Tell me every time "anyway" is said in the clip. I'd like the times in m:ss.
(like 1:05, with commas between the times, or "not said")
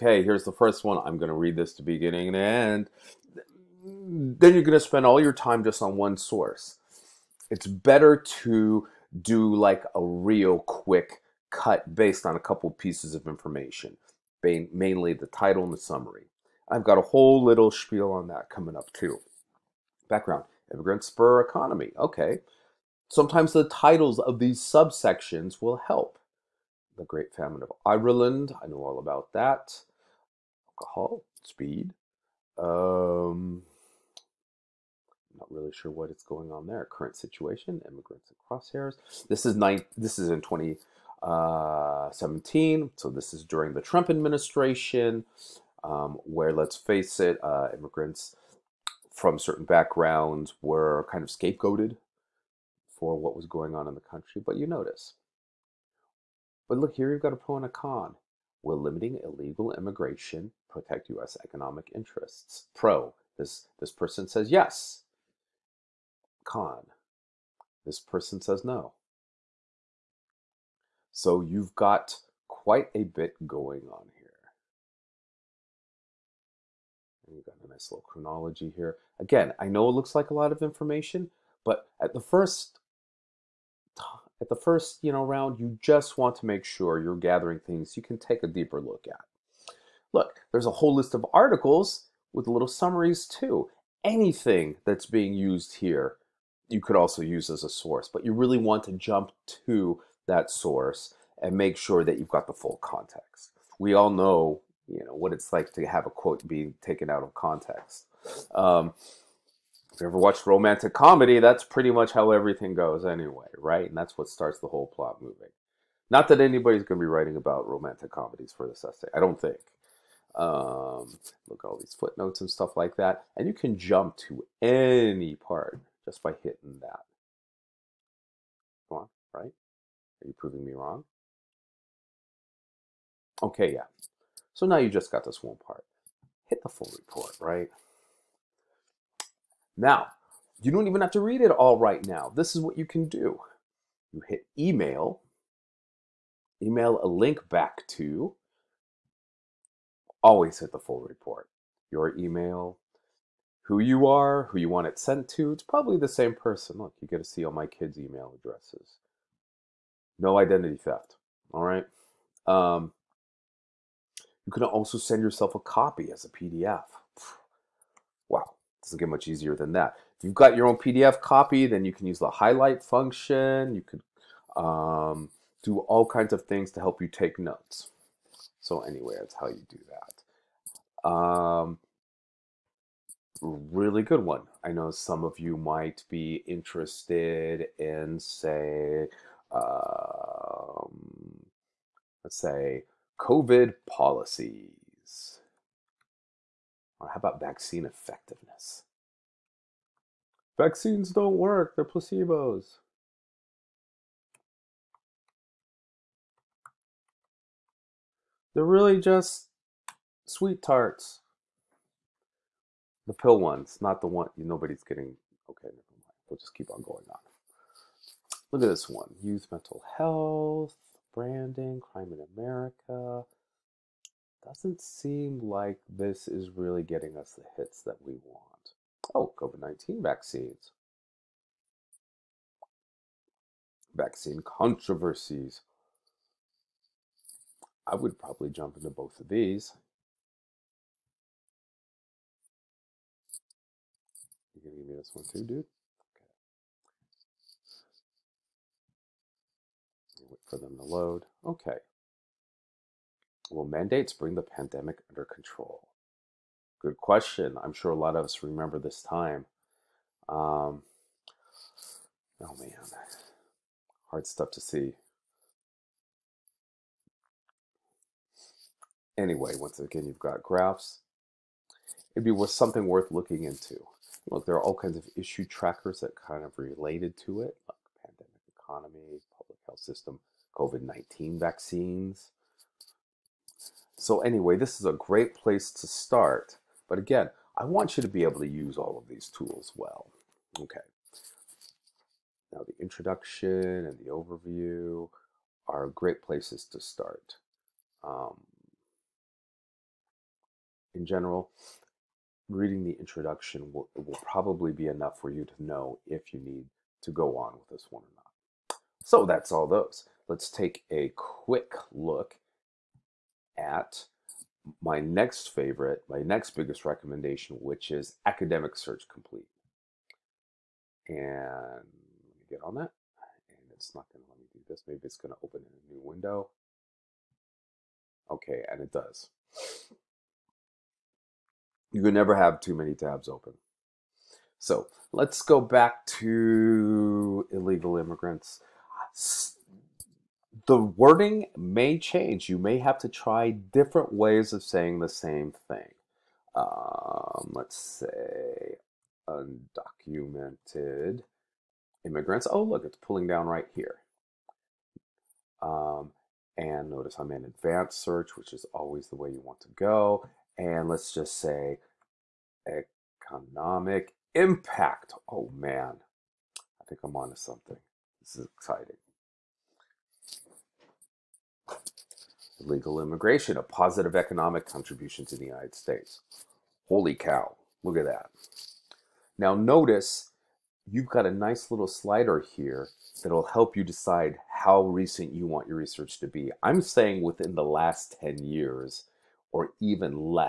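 1:53, 2:58, 4:29, 4:44.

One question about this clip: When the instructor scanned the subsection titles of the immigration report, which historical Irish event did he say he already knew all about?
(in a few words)
The Great Famine.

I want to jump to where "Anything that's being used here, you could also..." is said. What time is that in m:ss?
1:34.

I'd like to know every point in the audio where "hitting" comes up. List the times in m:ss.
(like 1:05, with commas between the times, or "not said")
2:06.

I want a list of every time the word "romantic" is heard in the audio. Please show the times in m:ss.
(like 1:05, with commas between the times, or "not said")
1:50, 1:57.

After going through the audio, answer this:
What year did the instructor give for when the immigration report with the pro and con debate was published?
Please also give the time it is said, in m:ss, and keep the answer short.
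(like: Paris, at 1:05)
2017, at 0:40.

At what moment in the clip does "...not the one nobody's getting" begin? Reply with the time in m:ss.
3:33.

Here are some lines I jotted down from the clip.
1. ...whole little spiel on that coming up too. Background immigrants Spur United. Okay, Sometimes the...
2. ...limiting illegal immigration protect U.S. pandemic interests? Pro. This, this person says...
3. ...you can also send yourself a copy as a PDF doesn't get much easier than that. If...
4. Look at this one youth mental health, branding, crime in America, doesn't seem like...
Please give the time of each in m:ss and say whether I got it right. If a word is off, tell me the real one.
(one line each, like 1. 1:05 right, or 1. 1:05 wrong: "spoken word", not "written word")
1. 0:17 wrong: "Economy", not "United"
2. 0:58 wrong: "economic", not "pandemic"
3. 2:44 right
4. 3:38 right.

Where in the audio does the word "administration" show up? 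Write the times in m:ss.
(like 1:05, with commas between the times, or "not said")
0:44.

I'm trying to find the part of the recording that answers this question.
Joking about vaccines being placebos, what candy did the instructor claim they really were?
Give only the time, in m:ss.
3:30.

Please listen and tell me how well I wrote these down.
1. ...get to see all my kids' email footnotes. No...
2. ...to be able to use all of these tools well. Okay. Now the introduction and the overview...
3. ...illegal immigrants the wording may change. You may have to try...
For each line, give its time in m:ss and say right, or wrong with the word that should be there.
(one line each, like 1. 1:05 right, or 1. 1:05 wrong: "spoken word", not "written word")
1. 2:37 wrong: "addresses", not "footnotes"
2. 4:48 right
3. 5:37 right.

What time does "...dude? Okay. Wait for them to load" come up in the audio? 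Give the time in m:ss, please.
4:05.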